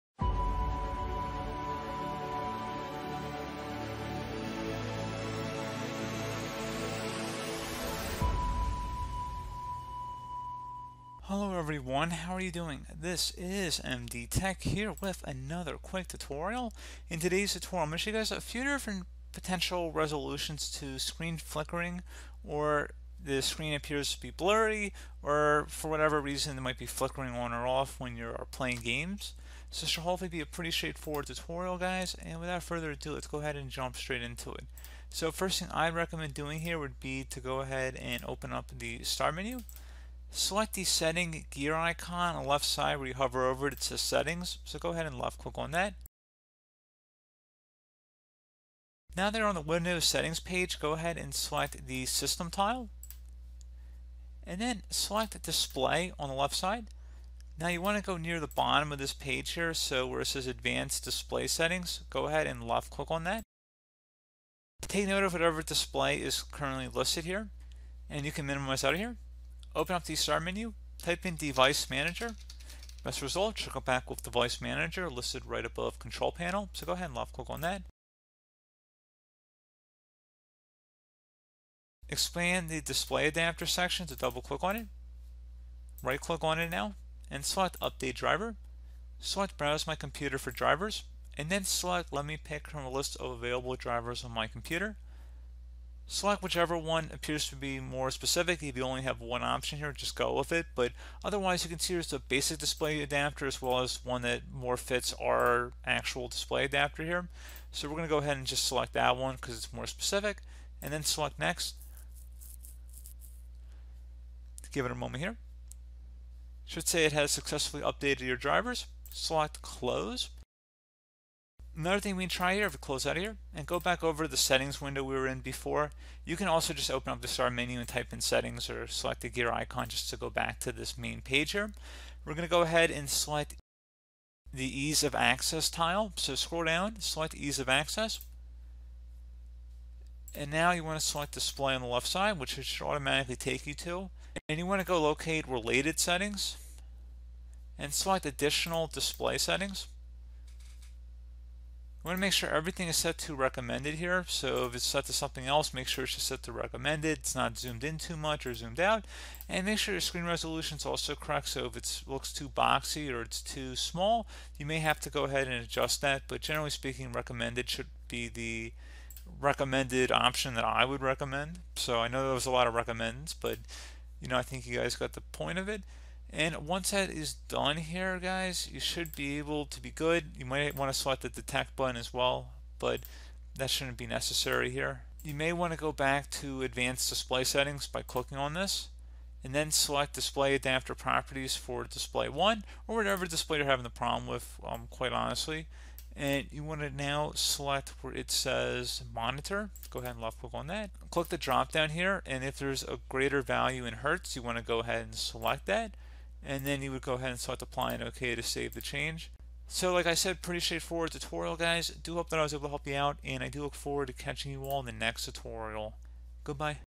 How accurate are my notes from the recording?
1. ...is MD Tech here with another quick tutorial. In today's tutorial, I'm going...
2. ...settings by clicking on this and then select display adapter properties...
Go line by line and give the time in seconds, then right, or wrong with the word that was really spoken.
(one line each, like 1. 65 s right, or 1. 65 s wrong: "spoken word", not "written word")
1. 13 s right
2. 187 s right.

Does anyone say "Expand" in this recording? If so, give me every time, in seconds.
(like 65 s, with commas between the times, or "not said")
82 s.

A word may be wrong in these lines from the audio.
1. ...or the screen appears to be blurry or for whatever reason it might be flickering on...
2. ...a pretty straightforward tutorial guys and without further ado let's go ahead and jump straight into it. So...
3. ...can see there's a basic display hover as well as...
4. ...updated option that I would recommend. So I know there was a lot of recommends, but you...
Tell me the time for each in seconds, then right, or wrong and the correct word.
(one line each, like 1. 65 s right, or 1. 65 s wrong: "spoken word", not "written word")
1. 22 s right
2. 30 s right
3. 101 s wrong: "adapter", not "hover"
4. 169 s wrong: "recommended", not "updated".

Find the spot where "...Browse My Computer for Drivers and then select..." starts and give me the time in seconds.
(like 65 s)
89 s.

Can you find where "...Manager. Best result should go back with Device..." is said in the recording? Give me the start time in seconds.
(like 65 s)
71 s.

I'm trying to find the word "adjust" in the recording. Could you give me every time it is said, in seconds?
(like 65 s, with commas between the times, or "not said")
165 s.